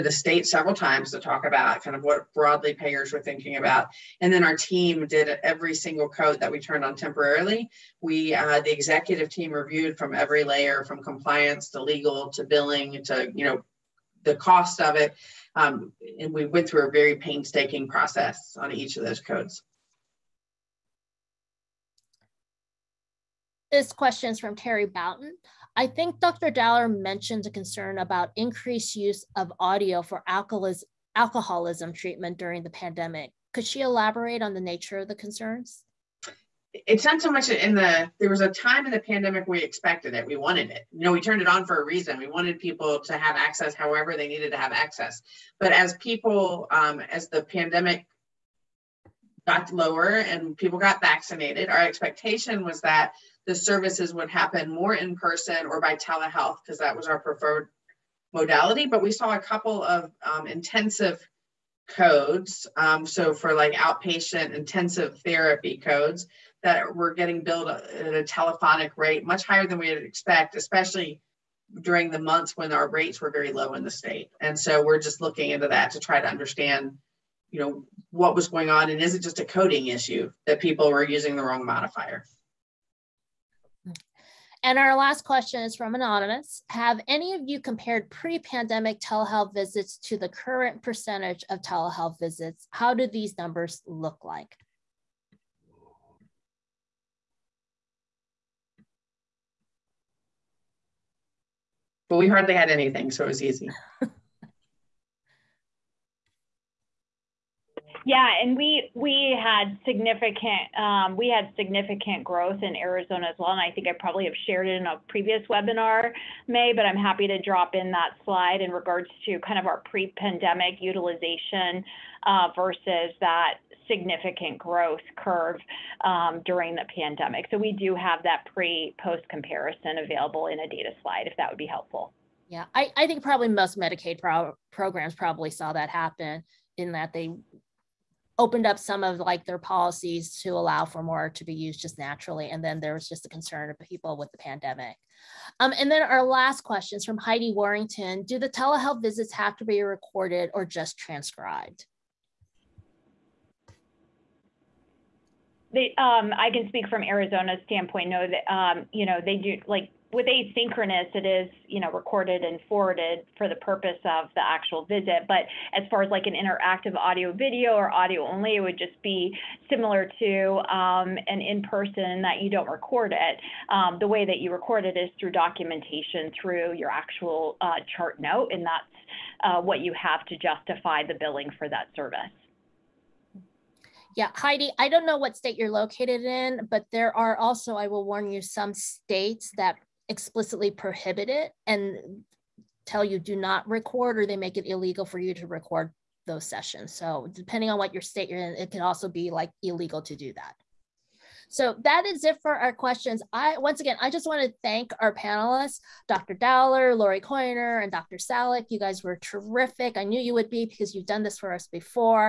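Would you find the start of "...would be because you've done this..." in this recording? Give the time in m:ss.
3:30.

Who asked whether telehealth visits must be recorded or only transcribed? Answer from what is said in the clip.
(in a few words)
Heidi Warrington.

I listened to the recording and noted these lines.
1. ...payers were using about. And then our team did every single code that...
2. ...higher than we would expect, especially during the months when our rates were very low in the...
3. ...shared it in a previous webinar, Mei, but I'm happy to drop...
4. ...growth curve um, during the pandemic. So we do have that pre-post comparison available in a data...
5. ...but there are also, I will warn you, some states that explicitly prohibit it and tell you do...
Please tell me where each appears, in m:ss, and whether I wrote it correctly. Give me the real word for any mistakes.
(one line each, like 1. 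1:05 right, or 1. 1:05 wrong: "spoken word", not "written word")
1. 0:02 wrong: "thinking", not "using"
2. 1:09 right
3. 1:54 right
4. 2:04 right
5. 3:06 right.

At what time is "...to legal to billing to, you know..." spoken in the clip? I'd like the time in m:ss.
0:11.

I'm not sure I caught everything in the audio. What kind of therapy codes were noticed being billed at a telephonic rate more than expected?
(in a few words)
outpatient intensive therapy.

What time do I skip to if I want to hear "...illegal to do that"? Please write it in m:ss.
3:19.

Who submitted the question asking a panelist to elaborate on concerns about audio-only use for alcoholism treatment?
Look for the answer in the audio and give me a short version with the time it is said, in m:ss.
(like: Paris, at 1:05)
Terry Boughton, at 0:24.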